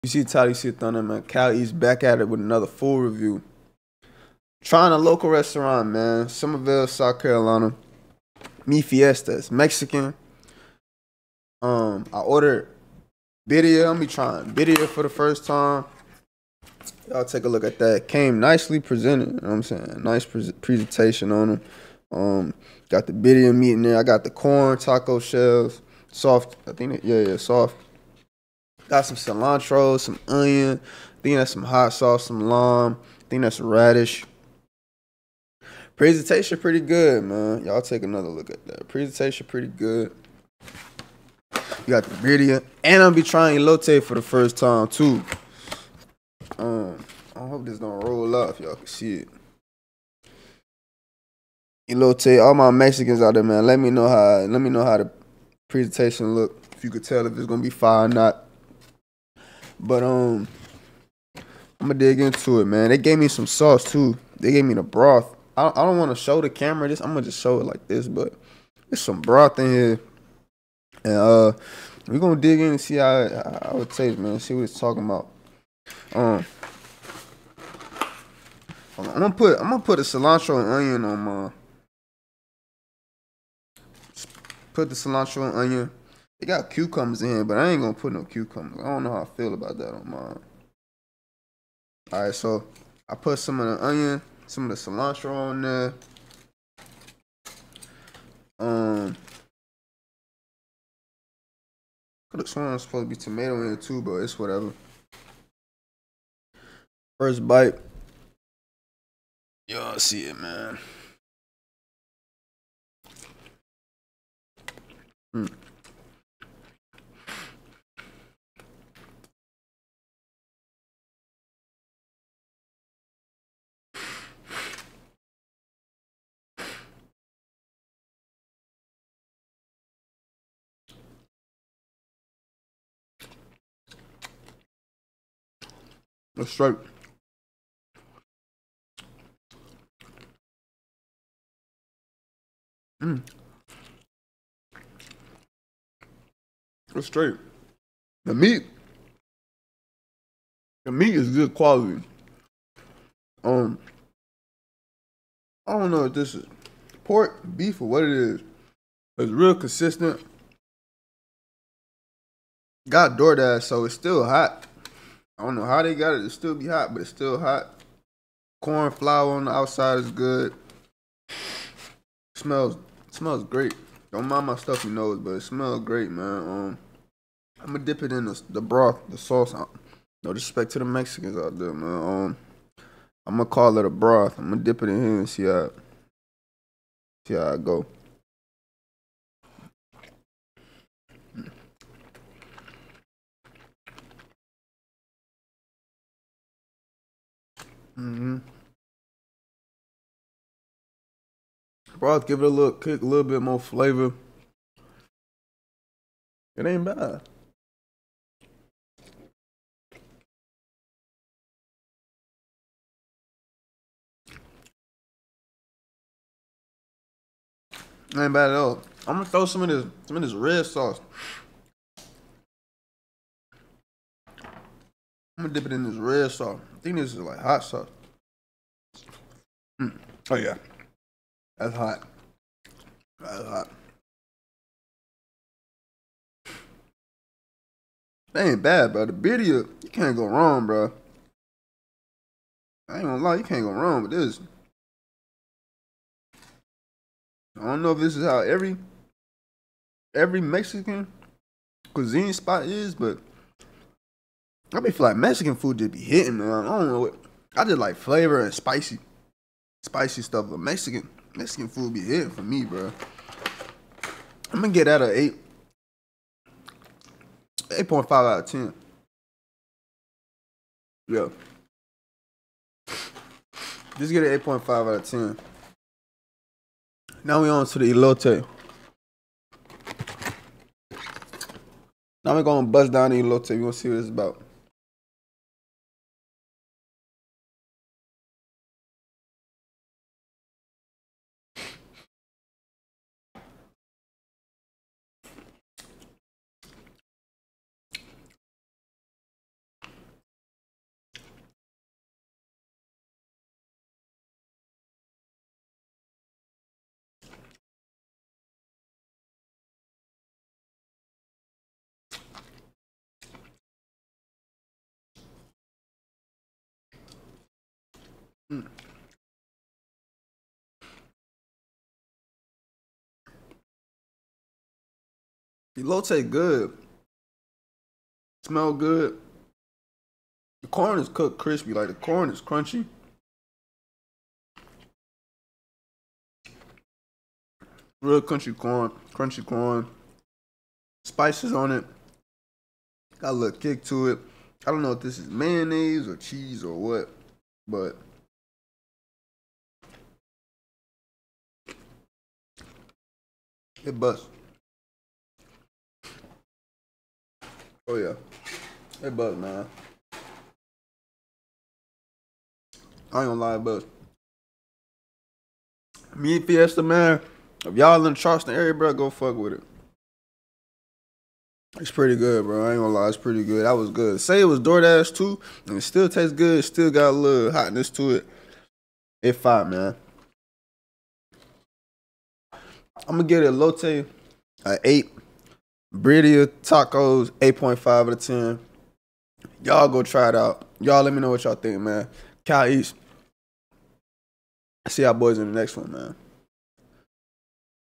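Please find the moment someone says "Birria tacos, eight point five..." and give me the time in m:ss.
6:25.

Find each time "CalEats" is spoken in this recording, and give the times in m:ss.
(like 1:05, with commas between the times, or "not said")
0:01, 6:32.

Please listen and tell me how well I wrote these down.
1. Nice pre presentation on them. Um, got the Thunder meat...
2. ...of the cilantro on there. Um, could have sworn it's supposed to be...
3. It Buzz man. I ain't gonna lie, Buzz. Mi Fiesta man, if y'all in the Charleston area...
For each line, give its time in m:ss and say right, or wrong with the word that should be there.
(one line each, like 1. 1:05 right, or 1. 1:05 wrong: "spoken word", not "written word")
1. 0:20 wrong: "Birria", not "Thunder"
2. 1:34 right
3. 5:59 right.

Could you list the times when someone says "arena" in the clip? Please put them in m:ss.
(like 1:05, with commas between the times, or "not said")
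not said.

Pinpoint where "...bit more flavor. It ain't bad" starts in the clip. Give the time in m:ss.
3:23.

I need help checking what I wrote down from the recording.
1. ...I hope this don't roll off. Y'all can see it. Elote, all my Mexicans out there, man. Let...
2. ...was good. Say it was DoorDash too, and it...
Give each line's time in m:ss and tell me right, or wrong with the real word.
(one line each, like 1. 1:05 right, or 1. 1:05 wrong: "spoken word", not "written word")
1. 0:47 right
2. 6:13 right.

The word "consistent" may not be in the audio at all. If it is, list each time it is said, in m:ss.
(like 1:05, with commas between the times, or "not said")
2:39.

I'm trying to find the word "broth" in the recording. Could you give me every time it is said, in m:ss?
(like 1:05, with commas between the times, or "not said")
1:04, 1:09, 2:58, 3:03, 3:22.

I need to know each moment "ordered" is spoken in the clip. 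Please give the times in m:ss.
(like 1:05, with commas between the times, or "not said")
0:12.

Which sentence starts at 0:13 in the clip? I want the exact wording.
I'm be trying Birria for the first time.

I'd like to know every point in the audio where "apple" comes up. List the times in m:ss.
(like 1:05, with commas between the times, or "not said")
not said.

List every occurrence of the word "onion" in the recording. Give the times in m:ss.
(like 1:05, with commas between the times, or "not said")
0:30, 1:20, 1:25, 1:33.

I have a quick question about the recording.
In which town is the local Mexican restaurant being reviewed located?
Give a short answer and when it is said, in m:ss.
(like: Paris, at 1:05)
Summerville, South Carolina, at 0:06.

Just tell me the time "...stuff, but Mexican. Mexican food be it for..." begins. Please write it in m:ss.
4:20.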